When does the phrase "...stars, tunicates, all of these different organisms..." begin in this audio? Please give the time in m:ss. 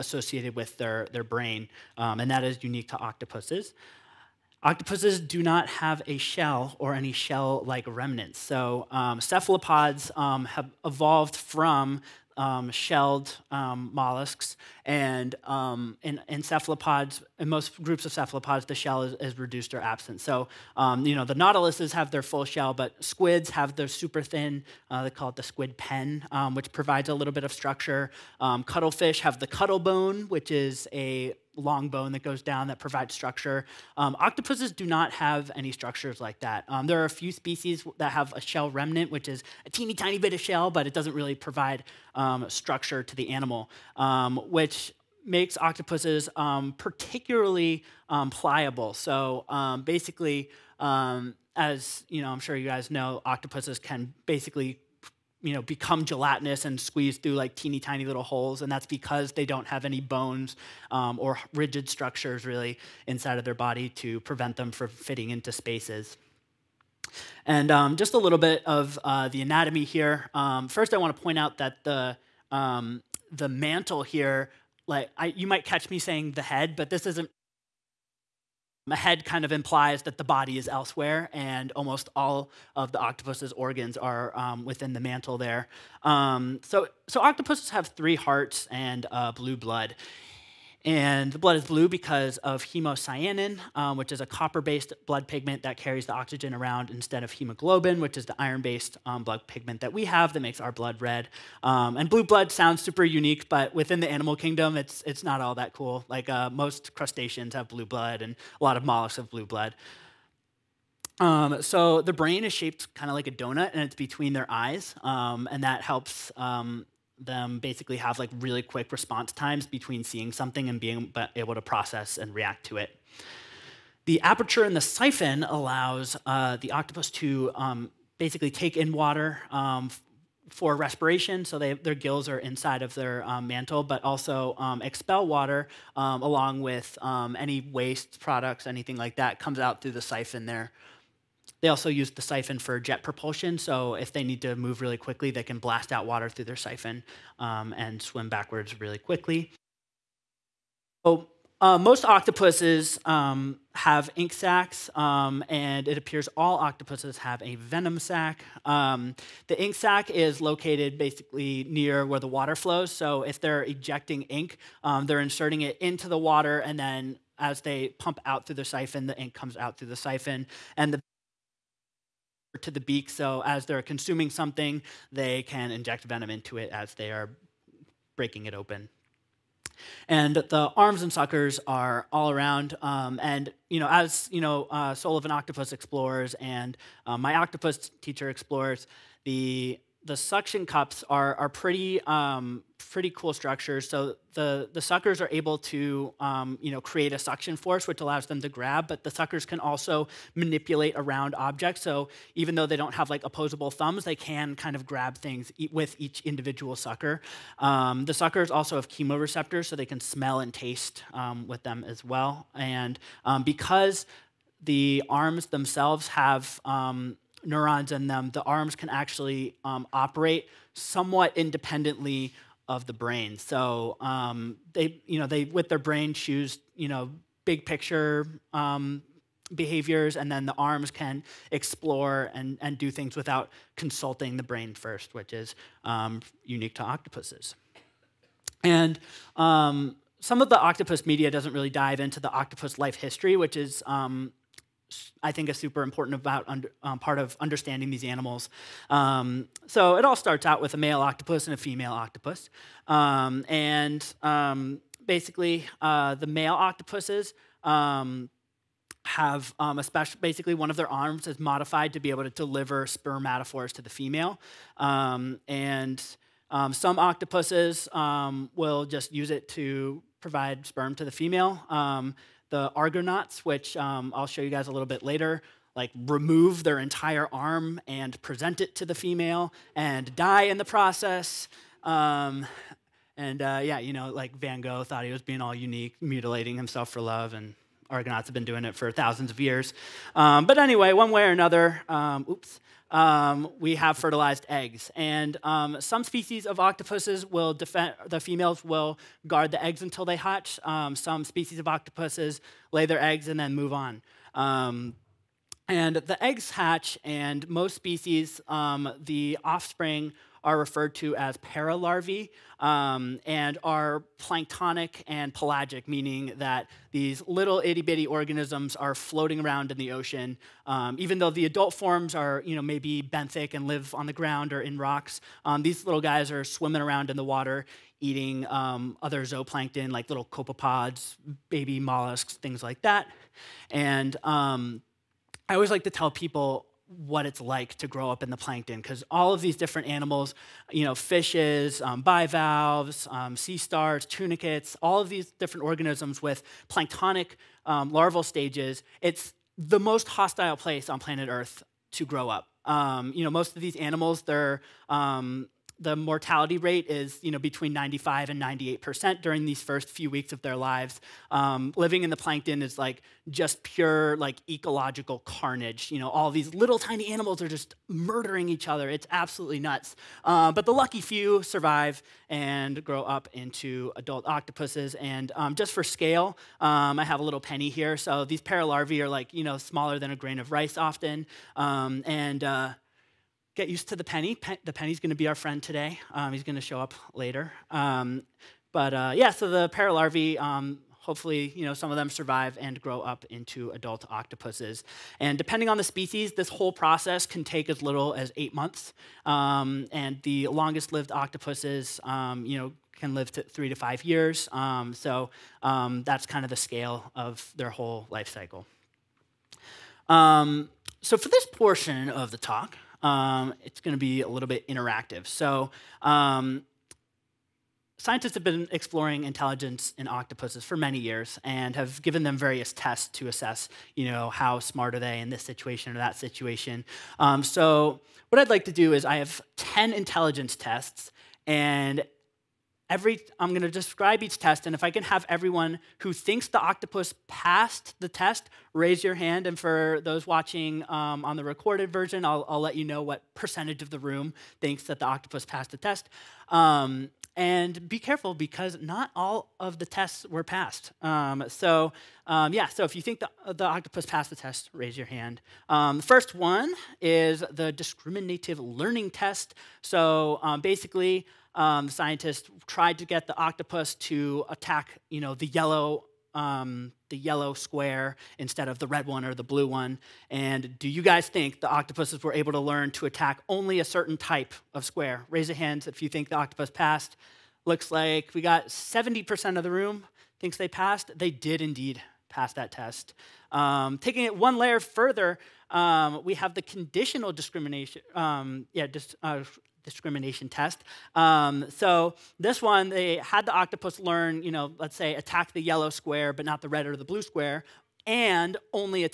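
5:43.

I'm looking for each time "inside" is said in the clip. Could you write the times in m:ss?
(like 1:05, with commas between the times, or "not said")
1:03, 2:12.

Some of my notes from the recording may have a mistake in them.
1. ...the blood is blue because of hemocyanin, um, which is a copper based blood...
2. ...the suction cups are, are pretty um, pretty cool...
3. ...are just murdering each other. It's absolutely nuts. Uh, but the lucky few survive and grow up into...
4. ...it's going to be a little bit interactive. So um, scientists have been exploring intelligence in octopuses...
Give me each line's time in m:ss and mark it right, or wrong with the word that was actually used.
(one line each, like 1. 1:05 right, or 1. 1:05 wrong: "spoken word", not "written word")
1. 1:31 right
2. 3:10 right
3. 6:07 right
4. 6:53 right.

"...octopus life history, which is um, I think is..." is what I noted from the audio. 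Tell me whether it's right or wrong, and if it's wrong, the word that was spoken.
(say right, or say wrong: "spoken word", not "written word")
right.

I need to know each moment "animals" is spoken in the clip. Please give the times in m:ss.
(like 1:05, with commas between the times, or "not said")
0:43, 1:44, 4:08, 5:39, 5:53, 6:07.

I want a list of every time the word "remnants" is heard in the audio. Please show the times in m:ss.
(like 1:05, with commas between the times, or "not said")
0:07, 0:38.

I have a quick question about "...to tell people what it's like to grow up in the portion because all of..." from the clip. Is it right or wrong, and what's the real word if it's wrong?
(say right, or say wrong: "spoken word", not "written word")
wrong: "plankton", not "portion".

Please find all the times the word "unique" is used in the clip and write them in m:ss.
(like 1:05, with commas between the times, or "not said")
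0:02, 1:43, 3:56, 4:45.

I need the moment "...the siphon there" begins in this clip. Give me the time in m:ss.
2:19.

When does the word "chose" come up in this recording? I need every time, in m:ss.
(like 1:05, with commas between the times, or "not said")
not said.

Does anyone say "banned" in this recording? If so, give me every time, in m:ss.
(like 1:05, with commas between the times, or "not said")
not said.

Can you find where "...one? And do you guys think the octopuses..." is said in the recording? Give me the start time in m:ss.
7:49.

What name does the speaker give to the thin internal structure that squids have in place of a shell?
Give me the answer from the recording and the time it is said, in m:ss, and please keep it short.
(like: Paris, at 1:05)
squid pen, at 0:25.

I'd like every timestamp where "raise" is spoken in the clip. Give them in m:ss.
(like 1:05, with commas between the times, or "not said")
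7:18, 7:34, 7:55.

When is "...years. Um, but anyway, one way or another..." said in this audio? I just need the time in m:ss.
4:49.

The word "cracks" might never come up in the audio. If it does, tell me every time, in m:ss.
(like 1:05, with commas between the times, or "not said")
not said.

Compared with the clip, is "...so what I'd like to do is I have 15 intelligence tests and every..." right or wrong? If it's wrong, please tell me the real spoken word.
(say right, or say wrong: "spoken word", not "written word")
wrong: "10", not "15".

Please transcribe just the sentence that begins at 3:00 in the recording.
And the arms and suckers are all around.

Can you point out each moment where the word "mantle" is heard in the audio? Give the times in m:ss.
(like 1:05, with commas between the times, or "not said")
1:13, 1:25, 2:13.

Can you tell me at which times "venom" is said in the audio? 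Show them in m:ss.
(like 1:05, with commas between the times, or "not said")
2:37, 2:56.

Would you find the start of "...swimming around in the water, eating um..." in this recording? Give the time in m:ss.
5:26.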